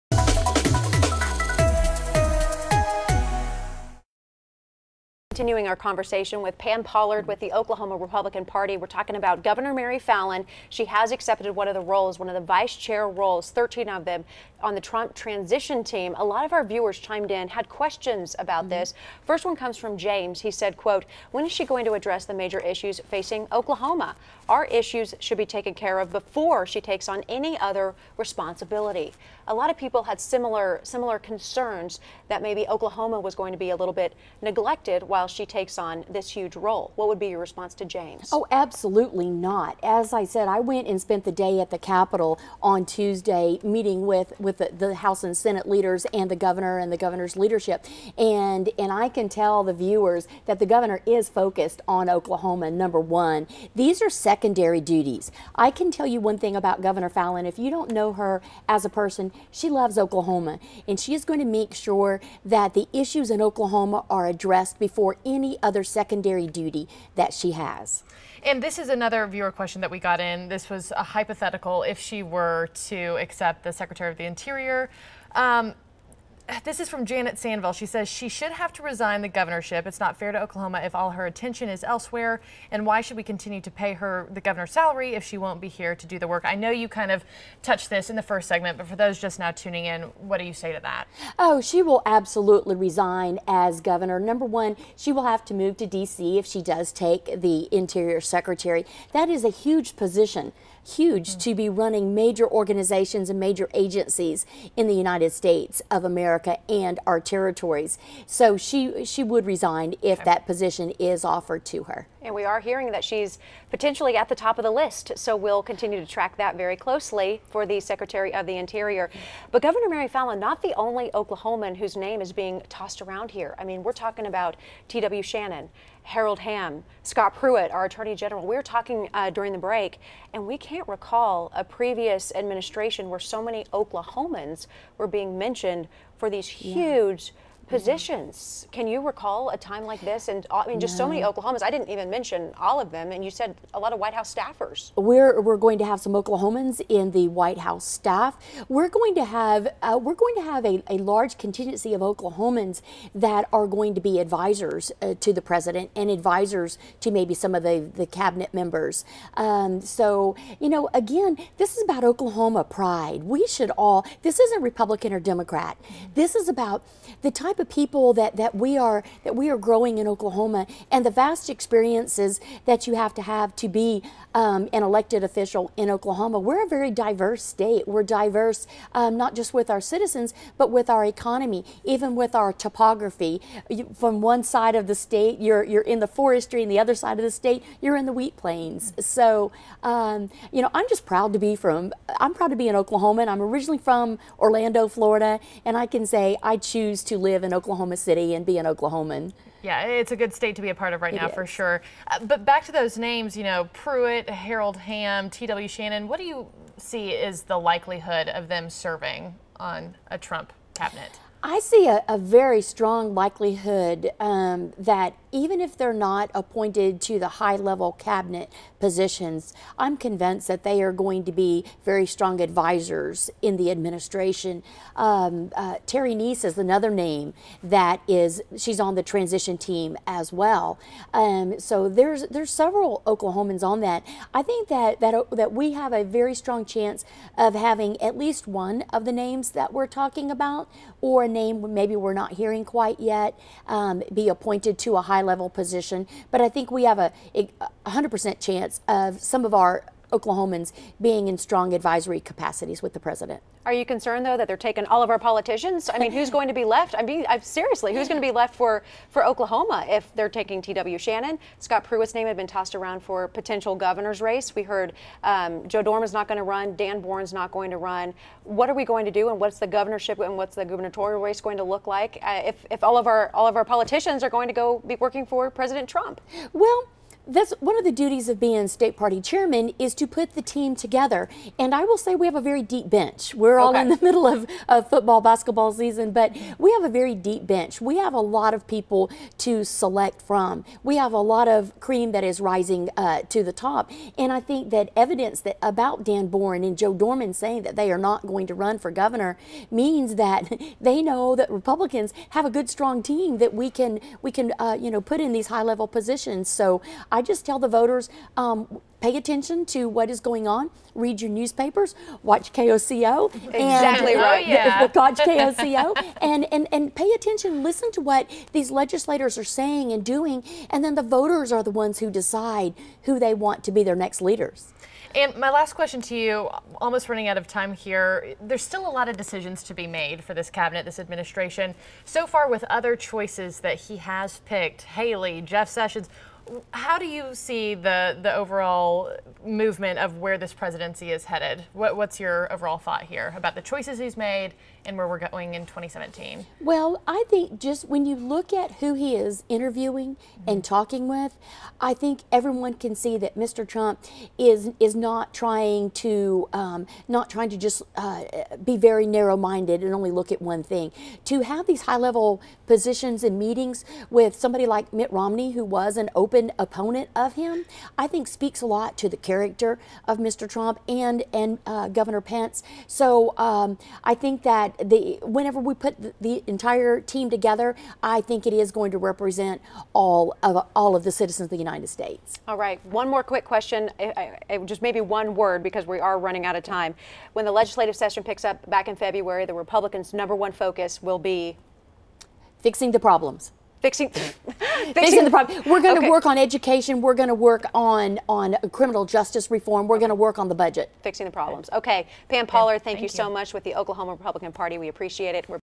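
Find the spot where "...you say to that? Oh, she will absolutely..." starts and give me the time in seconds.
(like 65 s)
90 s.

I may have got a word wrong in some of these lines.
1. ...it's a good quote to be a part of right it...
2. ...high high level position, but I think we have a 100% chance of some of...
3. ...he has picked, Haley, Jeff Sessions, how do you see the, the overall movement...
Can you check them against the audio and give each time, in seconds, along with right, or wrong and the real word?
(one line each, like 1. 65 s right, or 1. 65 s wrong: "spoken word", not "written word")
1. 199 s wrong: "state", not "quote"
2. 245 s right
3. 333 s right.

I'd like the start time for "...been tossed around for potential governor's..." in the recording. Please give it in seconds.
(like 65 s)
262 s.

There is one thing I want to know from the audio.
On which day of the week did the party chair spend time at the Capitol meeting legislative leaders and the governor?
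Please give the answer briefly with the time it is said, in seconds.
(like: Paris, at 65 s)
Tuesday, at 42 s.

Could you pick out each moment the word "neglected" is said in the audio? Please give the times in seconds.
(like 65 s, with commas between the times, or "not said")
34 s.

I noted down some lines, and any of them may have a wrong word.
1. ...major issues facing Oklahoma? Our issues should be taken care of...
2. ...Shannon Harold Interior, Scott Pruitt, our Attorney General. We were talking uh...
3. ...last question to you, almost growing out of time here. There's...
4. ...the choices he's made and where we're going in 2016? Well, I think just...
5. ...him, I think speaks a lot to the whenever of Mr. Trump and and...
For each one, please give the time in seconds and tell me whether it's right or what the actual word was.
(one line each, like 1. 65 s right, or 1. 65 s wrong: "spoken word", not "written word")
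1. 22 s right
2. 125 s wrong: "Hamm", not "Interior"
3. 325 s wrong: "running", not "growing"
4. 343 s wrong: "2017", not "2016"
5. 367 s wrong: "character", not "whenever".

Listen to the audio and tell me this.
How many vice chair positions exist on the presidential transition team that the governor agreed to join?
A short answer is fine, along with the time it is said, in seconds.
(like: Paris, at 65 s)
13, at 13 s.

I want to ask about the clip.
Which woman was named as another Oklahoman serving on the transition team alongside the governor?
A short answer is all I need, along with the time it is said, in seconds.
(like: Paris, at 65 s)
Terry Neese, at 225 s.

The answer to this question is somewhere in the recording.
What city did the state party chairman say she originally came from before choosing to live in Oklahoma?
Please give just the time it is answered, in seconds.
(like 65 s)
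194 s.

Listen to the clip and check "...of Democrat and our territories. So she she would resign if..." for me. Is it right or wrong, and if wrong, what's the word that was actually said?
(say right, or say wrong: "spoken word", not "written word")
wrong: "America", not "Democrat".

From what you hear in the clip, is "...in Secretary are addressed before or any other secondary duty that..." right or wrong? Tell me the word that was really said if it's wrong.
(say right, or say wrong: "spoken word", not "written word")
wrong: "Oklahoma", not "Secretary".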